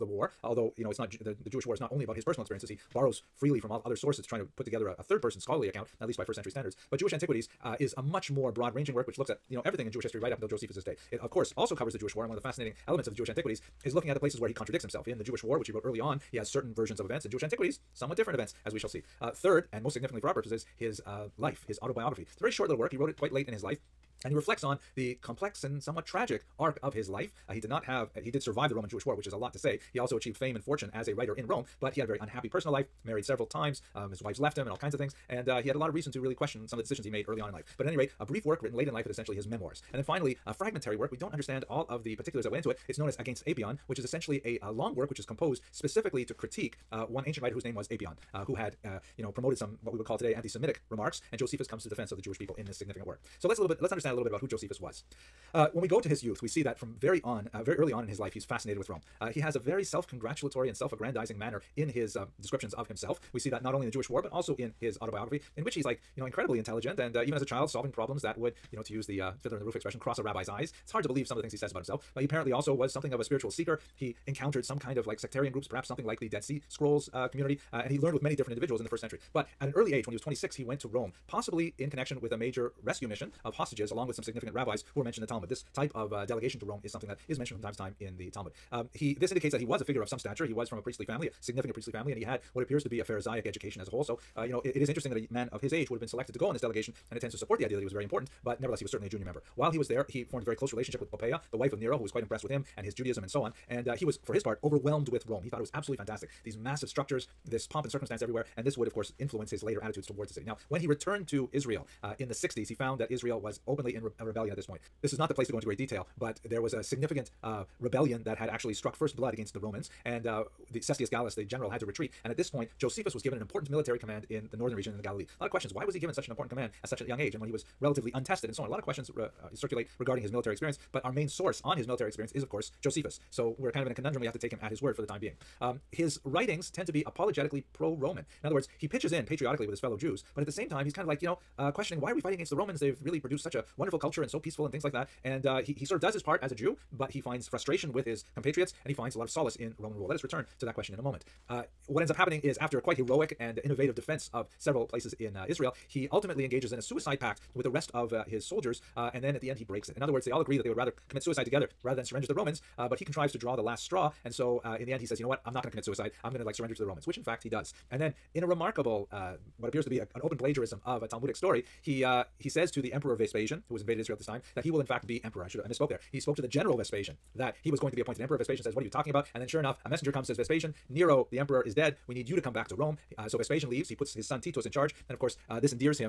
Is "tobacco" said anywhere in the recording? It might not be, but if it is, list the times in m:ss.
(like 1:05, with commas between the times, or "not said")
not said.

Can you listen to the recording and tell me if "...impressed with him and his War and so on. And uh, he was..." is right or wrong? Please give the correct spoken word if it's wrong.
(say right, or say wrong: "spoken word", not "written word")
wrong: "Judaism", not "War".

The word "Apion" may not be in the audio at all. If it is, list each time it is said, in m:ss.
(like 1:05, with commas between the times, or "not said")
0:43, 0:47.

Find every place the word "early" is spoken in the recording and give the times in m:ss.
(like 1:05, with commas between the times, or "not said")
0:15, 0:37, 0:57, 1:19.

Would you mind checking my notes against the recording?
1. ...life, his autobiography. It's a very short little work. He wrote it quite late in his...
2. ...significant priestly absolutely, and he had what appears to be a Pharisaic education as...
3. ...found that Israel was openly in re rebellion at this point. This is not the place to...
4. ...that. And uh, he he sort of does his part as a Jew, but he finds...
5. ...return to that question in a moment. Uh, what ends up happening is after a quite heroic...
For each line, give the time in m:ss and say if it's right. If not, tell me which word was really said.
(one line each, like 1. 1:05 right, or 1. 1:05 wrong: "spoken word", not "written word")
1. 0:21 right
2. 1:31 wrong: "family", not "absolutely"
3. 1:52 right
4. 2:24 right
5. 2:30 right.